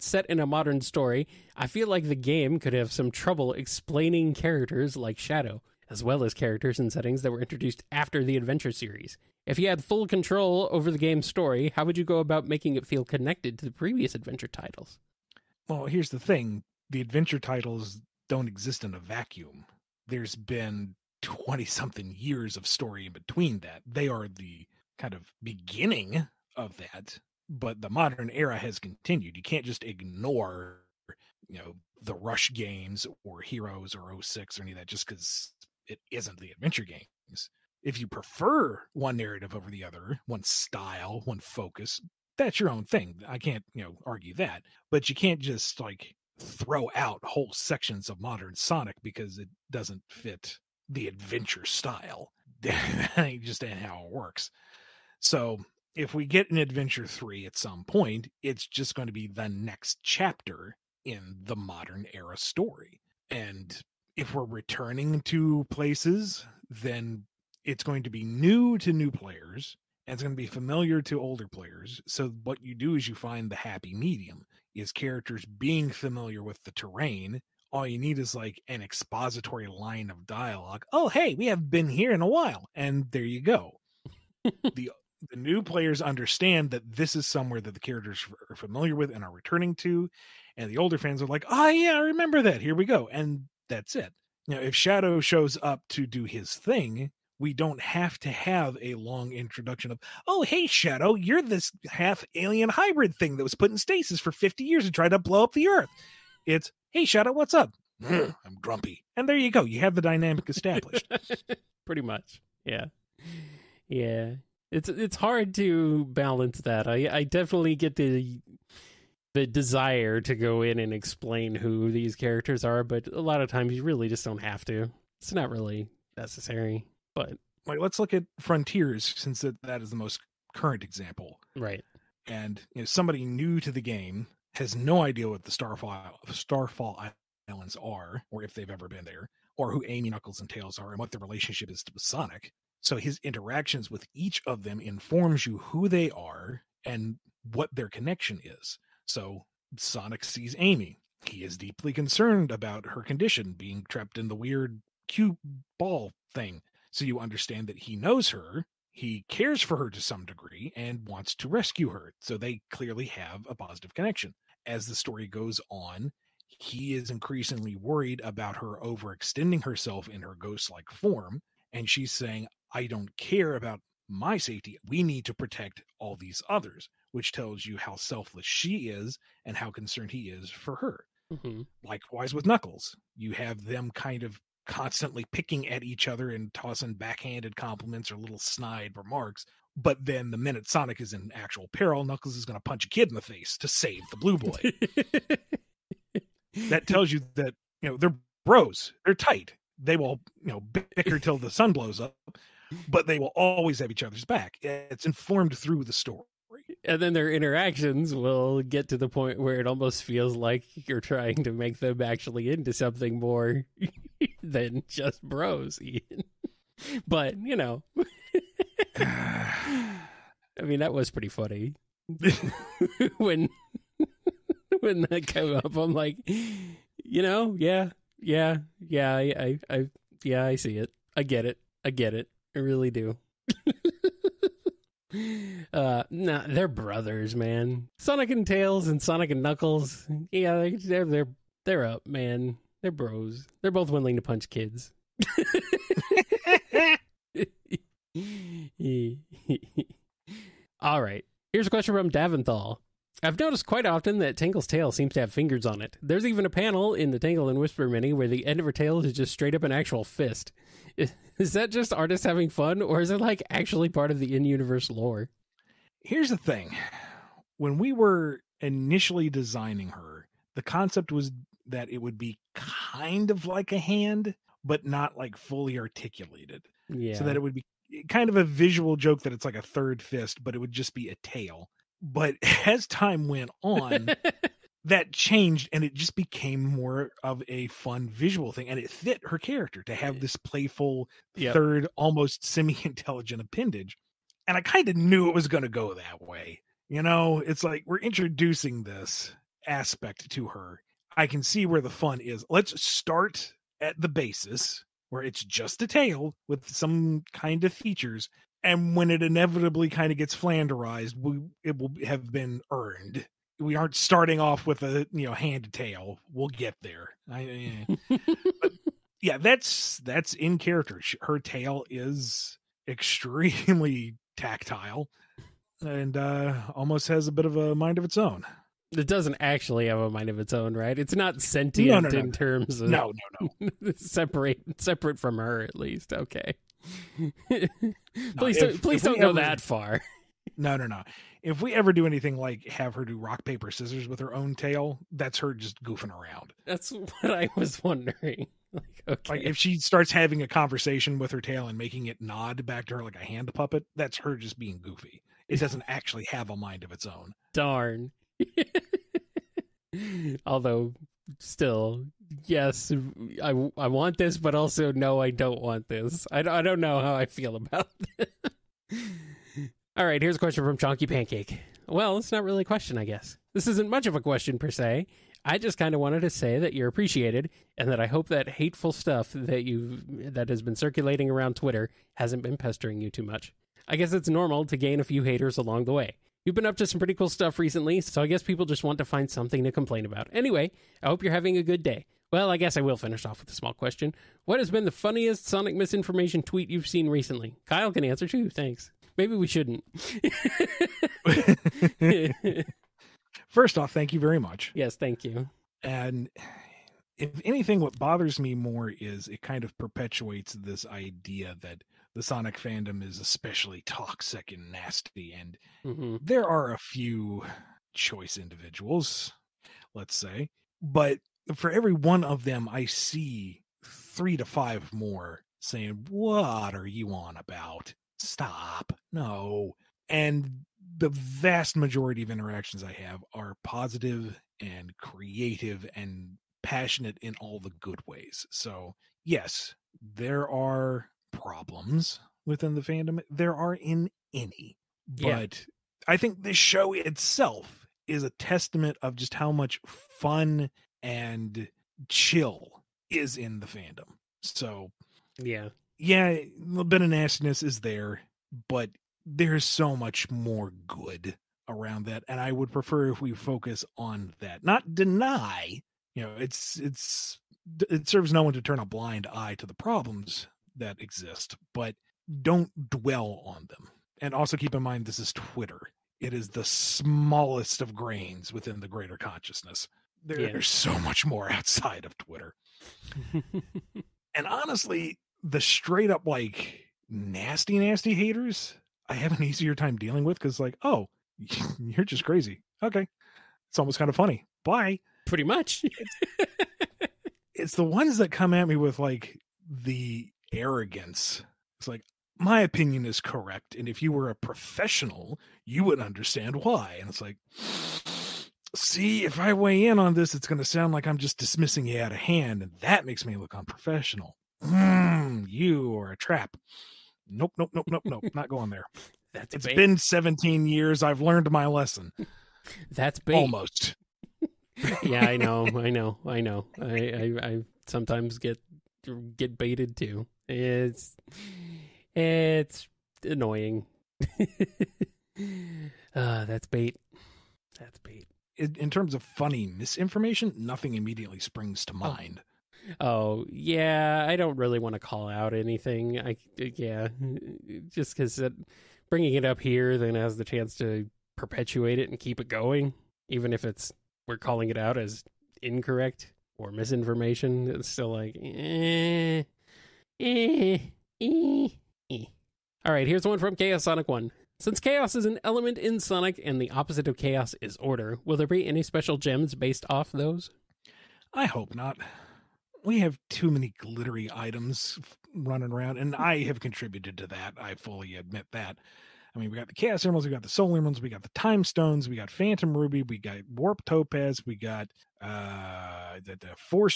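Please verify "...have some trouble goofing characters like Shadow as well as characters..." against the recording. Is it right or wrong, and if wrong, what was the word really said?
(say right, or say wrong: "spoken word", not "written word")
wrong: "explaining", not "goofing".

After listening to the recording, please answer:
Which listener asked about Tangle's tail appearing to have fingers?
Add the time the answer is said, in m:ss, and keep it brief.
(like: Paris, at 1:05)
Daventhal, at 4:12.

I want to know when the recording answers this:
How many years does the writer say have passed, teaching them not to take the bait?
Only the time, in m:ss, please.
8:39.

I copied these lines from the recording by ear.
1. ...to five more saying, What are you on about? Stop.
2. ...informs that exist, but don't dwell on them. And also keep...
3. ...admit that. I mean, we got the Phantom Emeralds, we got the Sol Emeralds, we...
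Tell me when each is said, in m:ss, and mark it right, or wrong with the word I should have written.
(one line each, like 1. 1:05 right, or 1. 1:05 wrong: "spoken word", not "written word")
1. 7:04 right
2. 7:49 wrong: "problems", not "informs"
3. 9:38 wrong: "Chaos", not "Phantom".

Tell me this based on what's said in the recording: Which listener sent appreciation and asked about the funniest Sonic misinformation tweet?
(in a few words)
Chonky Pancake.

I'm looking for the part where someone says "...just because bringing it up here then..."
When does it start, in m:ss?
9:07.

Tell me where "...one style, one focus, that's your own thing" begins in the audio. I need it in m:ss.
0:40.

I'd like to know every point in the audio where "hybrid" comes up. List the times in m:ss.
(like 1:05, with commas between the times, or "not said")
1:42.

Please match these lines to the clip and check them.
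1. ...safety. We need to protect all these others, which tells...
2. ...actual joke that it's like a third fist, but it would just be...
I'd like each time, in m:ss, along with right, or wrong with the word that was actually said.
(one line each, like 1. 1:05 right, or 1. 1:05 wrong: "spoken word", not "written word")
1. 2:54 right
2. 4:38 wrong: "visual", not "actual".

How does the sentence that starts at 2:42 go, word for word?
So they clearly have a positive connection.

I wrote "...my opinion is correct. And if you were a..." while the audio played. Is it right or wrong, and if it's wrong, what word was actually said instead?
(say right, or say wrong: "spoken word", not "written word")
right.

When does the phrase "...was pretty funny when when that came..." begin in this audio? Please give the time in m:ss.
3:40.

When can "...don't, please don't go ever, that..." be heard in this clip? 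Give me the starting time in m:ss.
5:38.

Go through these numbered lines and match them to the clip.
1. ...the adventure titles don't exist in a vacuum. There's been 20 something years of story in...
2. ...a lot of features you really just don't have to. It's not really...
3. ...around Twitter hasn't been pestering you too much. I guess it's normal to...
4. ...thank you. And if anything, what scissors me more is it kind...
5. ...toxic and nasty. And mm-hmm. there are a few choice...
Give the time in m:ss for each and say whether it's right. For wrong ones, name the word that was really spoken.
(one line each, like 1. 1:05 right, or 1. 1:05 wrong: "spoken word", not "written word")
1. 0:16 right
2. 2:03 wrong: "times", not "features"
3. 6:21 right
4. 6:44 wrong: "bothers", not "scissors"
5. 6:53 right.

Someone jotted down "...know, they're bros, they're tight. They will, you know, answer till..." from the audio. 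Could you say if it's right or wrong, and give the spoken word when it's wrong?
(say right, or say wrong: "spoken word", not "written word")
wrong: "bicker", not "answer".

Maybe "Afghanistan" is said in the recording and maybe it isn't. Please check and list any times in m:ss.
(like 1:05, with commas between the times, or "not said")
not said.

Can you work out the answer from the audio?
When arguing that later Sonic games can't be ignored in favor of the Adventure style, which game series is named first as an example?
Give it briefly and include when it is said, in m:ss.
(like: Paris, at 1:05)
Rush, at 0:32.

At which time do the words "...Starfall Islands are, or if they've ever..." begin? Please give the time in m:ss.
2:16.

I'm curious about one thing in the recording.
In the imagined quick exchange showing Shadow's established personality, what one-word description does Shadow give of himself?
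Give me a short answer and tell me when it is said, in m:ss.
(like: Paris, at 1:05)
Grumpy, at 1:48.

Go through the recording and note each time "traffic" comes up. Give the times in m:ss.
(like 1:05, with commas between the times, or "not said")
not said.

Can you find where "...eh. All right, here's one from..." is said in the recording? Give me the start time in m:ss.
9:22.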